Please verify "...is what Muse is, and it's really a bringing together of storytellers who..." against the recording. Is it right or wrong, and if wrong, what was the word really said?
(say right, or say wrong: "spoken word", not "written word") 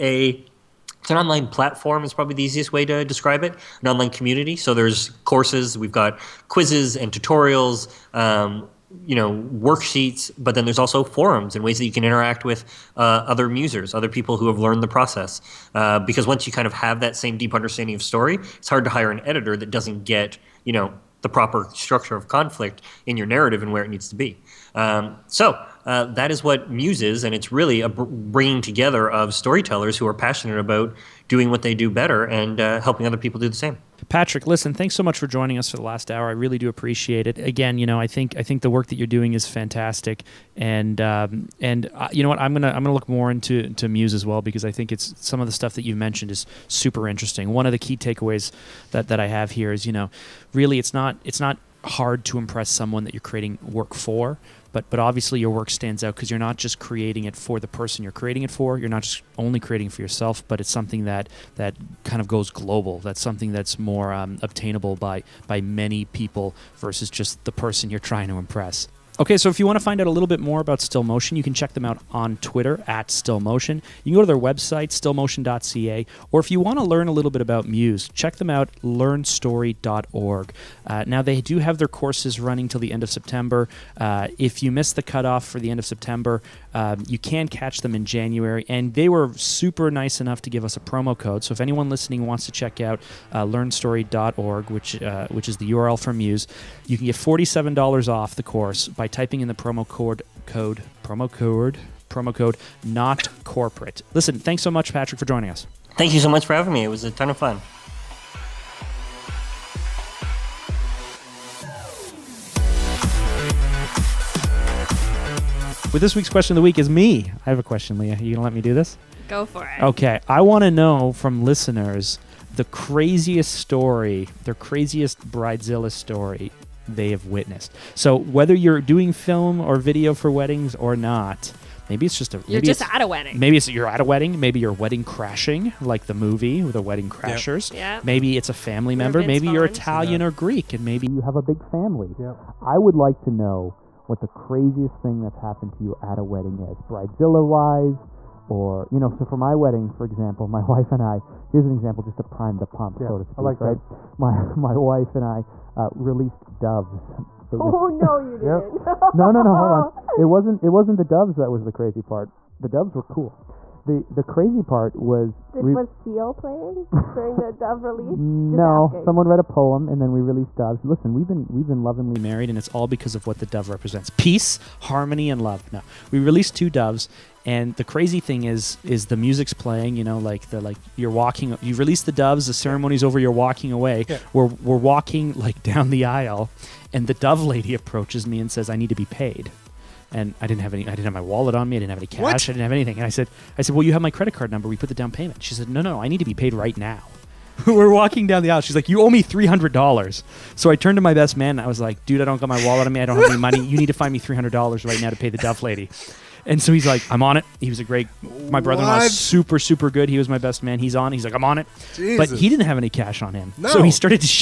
right.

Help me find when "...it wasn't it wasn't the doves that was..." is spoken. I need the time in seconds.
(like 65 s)
160 s.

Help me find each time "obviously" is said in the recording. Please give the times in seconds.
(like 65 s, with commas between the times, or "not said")
54 s.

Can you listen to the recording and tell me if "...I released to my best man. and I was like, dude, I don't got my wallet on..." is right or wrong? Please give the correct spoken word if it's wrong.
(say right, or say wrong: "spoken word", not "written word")
wrong: "turned", not "released".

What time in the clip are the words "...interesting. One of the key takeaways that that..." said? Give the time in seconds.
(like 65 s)
47 s.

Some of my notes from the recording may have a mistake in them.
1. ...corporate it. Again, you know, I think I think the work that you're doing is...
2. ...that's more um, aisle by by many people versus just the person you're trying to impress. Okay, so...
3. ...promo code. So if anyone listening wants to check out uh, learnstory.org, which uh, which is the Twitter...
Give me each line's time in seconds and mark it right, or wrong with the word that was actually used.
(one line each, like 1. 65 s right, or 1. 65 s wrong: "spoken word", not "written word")
1. 36 s wrong: "appreciate", not "corporate"
2. 63 s wrong: "obtainable", not "aisle"
3. 90 s wrong: "URL", not "Twitter".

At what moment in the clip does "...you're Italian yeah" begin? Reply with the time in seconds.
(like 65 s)
139 s.